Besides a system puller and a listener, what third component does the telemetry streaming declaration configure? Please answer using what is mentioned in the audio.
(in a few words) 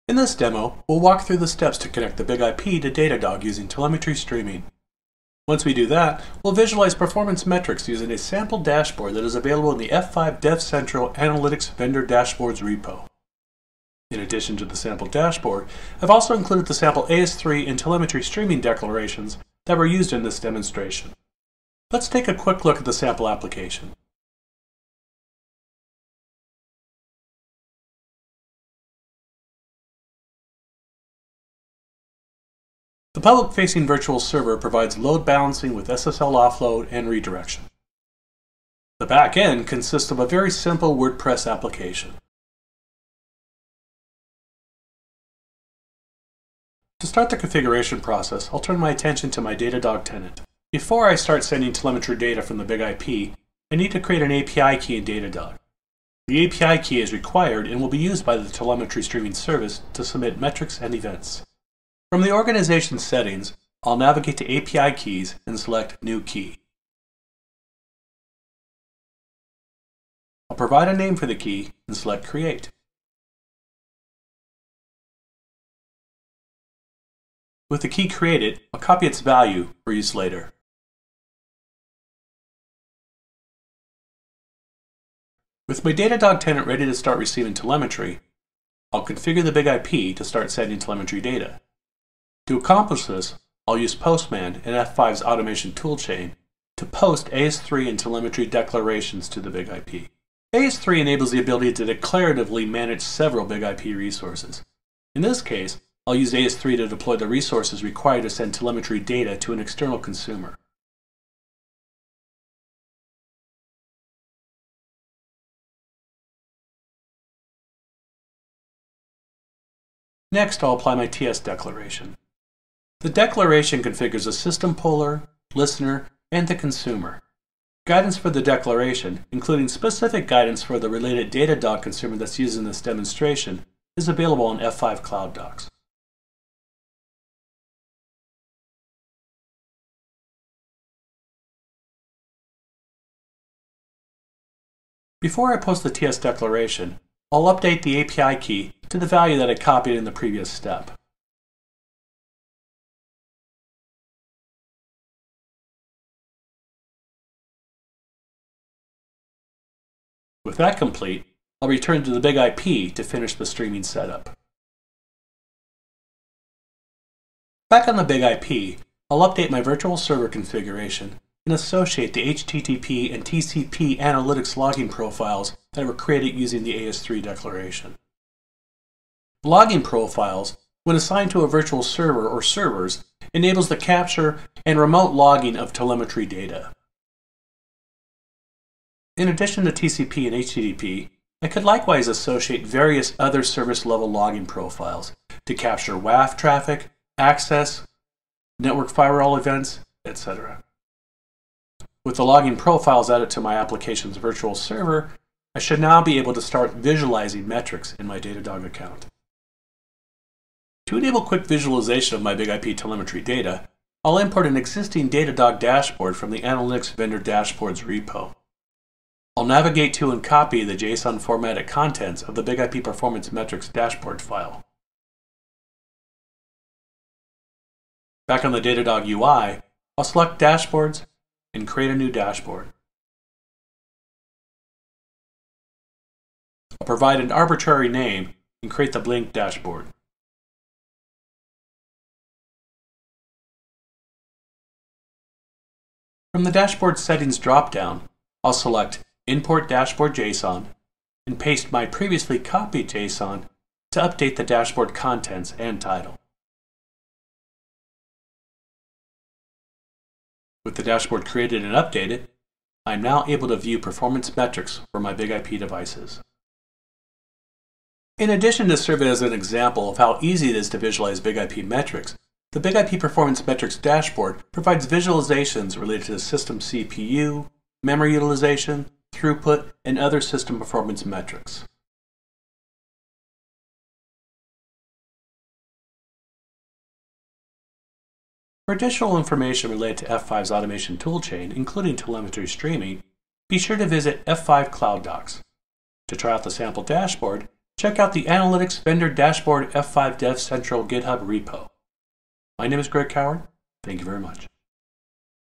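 the consumer.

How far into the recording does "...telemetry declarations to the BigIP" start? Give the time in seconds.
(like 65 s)
97 s.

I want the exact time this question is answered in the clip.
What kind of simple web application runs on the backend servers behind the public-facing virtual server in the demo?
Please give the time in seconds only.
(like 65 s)
40 s.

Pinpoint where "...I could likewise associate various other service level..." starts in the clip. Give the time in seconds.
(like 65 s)
191 s.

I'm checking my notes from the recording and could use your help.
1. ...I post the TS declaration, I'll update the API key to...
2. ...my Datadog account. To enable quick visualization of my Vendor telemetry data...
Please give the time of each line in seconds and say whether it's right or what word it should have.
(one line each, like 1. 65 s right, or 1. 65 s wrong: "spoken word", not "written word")
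1. 145 s right
2. 208 s wrong: "BigIP", not "Vendor".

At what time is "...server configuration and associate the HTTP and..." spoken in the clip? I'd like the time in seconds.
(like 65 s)
169 s.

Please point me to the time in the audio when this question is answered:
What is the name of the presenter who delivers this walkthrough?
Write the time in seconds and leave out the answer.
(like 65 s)
302 s.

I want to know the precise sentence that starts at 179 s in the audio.
Logging profiles, when assigned to a virtual server or servers, enables the capture and remote logging of telemetry data.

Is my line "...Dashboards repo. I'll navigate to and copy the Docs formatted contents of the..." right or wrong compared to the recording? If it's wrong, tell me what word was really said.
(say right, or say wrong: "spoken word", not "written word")
wrong: "JSON", not "Docs".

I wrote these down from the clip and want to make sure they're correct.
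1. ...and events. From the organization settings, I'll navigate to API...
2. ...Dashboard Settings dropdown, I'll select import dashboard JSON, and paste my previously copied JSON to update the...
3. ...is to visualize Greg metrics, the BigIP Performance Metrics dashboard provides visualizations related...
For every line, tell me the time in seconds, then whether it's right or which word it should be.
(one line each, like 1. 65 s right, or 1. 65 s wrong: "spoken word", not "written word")
1. 60 s right
2. 246 s right
3. 270 s wrong: "BigIP", not "Greg".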